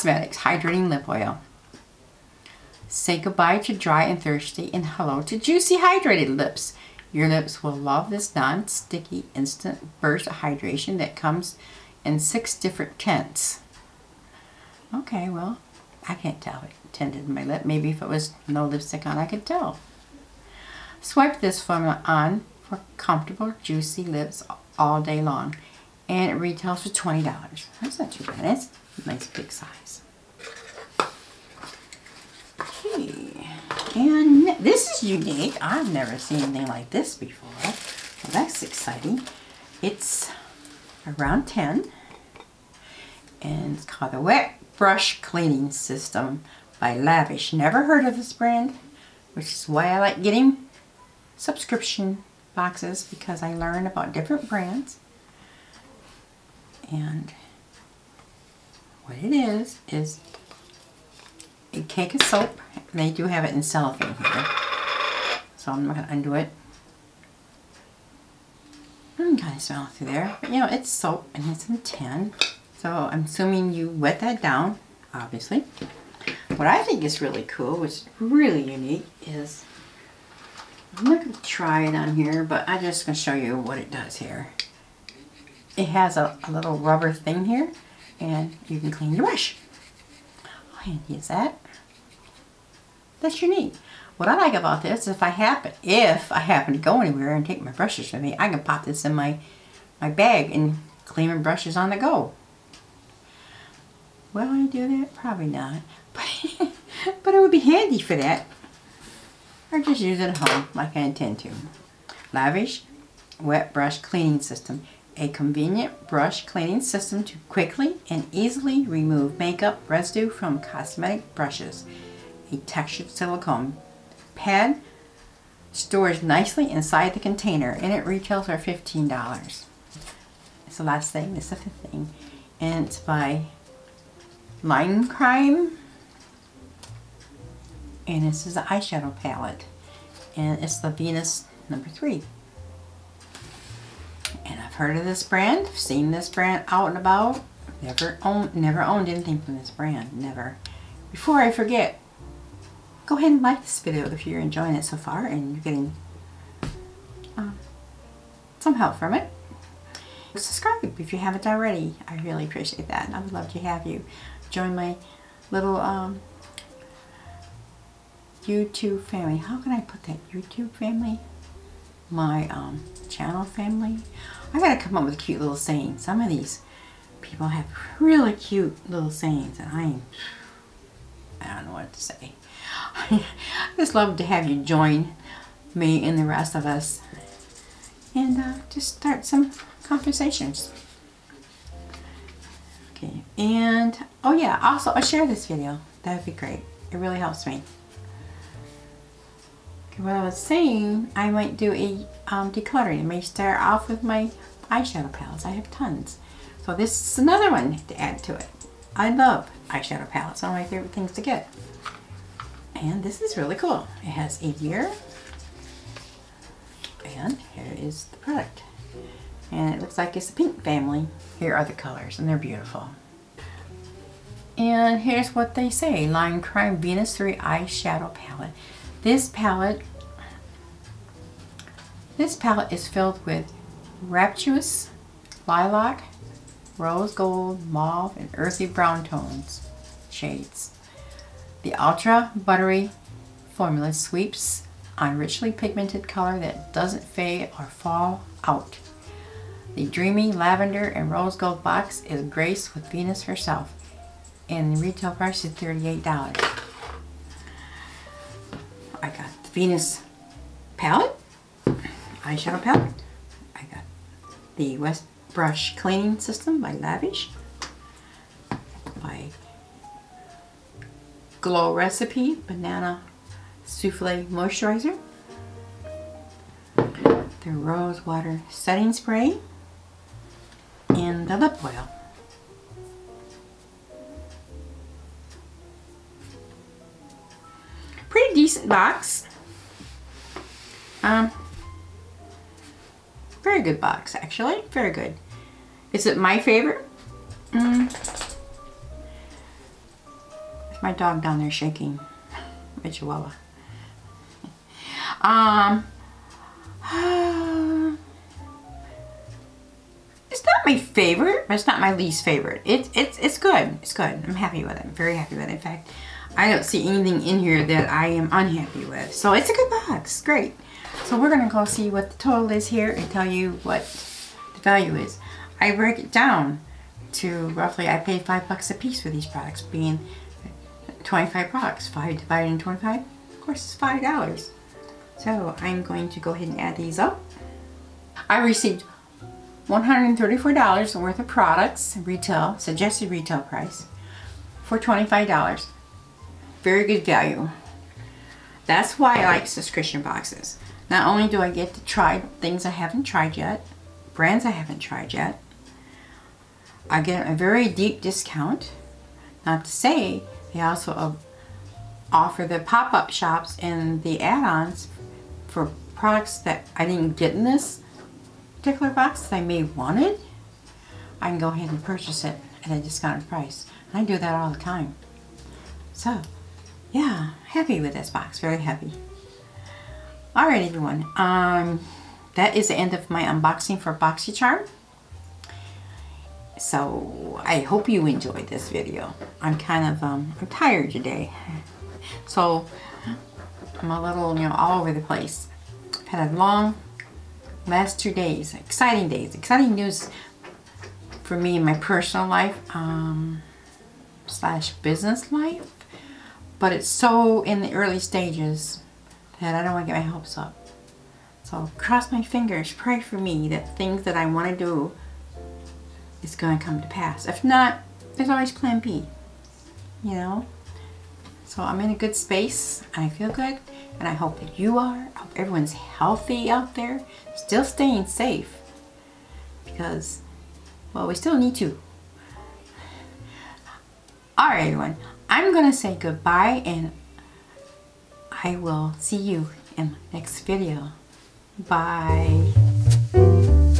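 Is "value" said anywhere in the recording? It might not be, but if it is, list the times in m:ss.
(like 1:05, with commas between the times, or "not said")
5:24, 5:47.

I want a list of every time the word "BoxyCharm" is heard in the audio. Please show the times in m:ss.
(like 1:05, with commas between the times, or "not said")
6:23.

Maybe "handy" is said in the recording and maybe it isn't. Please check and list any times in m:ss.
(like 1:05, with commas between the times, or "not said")
1:30, 1:47.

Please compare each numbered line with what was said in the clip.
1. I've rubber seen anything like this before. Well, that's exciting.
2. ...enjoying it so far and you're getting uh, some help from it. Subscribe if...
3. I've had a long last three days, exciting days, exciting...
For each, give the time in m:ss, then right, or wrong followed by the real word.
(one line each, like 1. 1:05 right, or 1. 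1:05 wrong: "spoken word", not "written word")
1. 0:35 wrong: "never", not "rubber"
2. 2:34 right
3. 6:36 wrong: "two", not "three".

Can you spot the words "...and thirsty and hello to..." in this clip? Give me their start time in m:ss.
0:04.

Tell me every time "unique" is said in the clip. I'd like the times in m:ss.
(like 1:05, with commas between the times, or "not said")
0:35, 1:18, 1:33.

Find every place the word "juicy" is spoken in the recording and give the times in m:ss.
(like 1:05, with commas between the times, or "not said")
0:05, 0:23.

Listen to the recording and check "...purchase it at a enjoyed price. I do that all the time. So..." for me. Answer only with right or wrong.
wrong.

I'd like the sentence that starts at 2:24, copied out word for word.
And I've heard of this brand, seen this brand out and about.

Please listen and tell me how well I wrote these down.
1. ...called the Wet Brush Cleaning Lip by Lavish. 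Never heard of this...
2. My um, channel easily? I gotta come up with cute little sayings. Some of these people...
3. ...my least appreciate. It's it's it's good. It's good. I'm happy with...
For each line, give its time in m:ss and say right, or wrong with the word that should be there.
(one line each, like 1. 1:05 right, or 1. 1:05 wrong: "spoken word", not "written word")
1. 0:43 wrong: "System", not "Lip"
2. 2:52 wrong: "family", not "easily"
3. 5:11 wrong: "favorite", not "appreciate".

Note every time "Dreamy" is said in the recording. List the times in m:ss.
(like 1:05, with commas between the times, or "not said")
4:09.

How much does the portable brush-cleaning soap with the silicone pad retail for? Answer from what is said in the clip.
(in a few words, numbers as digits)
$15.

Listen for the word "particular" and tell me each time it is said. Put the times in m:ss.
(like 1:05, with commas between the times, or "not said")
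6:08.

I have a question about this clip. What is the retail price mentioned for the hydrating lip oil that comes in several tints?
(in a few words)
$20.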